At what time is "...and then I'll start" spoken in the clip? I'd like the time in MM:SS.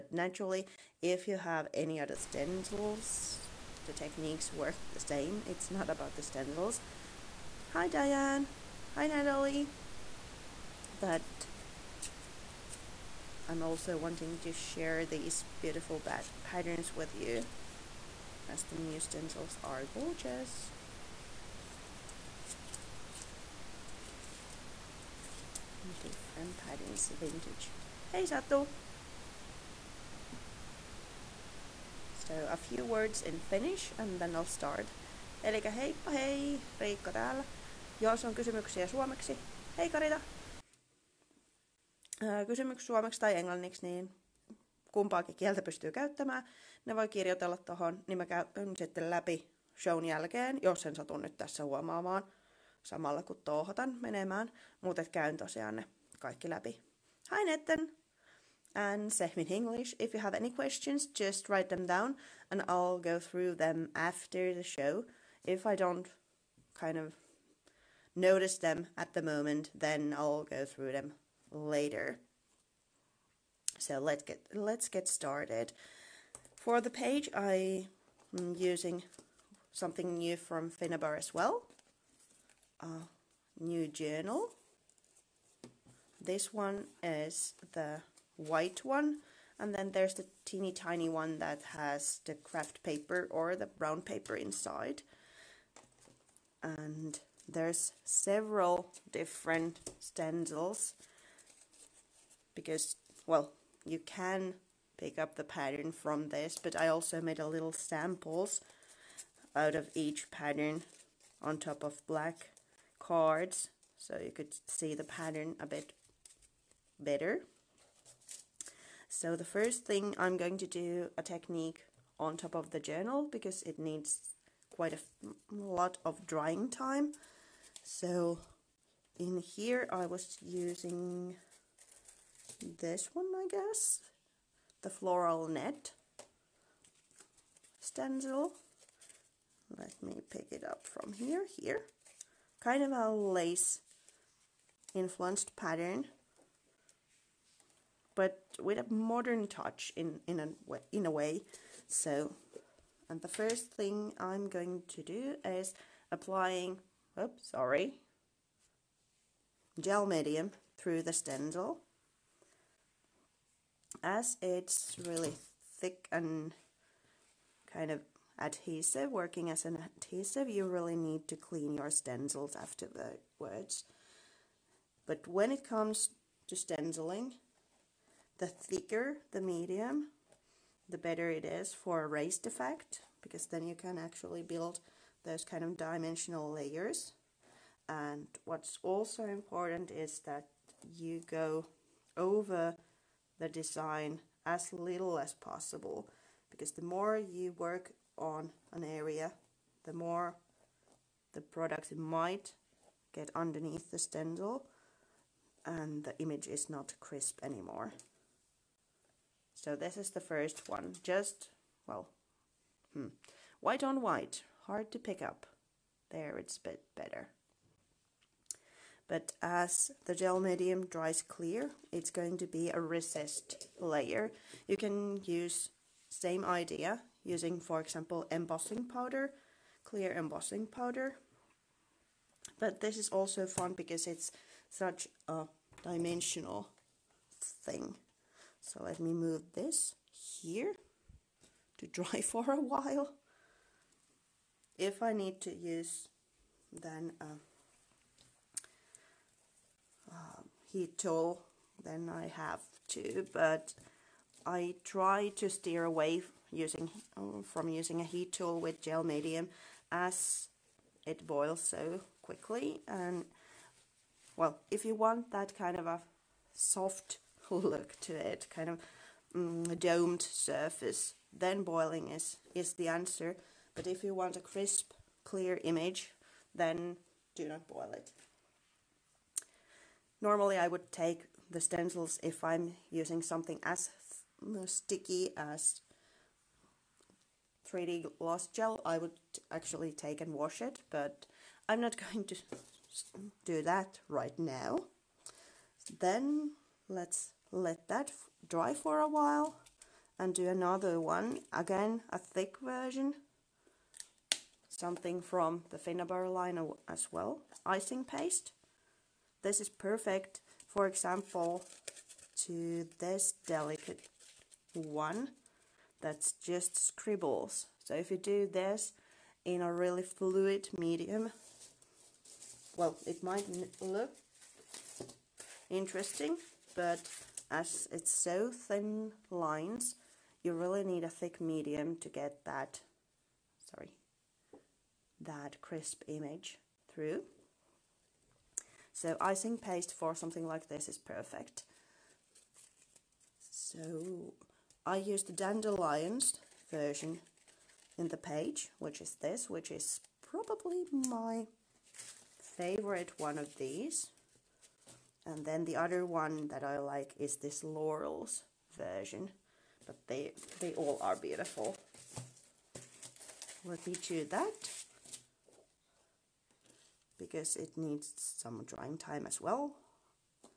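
00:33.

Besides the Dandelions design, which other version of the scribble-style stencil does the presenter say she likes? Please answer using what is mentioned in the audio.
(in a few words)
Laurels.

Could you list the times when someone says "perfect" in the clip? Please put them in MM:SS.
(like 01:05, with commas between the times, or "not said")
05:09, 05:40.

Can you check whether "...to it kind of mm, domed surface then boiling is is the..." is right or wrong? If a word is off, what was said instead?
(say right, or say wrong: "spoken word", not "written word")
right.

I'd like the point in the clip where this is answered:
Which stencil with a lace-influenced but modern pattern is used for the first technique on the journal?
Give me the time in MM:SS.
02:14.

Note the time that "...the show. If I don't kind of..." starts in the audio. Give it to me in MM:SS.
01:04.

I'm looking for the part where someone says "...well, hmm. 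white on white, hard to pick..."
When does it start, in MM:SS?
03:31.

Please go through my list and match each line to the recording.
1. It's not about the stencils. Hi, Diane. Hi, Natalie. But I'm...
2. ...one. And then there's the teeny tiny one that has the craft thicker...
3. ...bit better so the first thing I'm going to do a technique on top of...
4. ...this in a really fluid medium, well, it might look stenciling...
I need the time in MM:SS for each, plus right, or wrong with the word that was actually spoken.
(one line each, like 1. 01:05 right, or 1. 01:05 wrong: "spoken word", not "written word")
1. 00:05 right
2. 01:28 wrong: "paper", not "thicker"
3. 01:55 right
4. 05:18 wrong: "interesting", not "stenciling".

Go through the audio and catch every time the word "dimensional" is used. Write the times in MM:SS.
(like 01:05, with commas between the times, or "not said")
03:05, 03:55.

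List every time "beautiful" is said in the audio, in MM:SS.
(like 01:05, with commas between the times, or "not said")
00:15, 06:01.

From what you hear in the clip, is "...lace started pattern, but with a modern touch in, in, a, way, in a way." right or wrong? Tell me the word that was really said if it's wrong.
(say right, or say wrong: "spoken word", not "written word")
wrong: "influenced", not "started".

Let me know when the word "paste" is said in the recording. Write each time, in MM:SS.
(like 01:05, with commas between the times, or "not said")
05:08, 05:39.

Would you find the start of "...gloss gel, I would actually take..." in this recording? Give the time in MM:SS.
04:48.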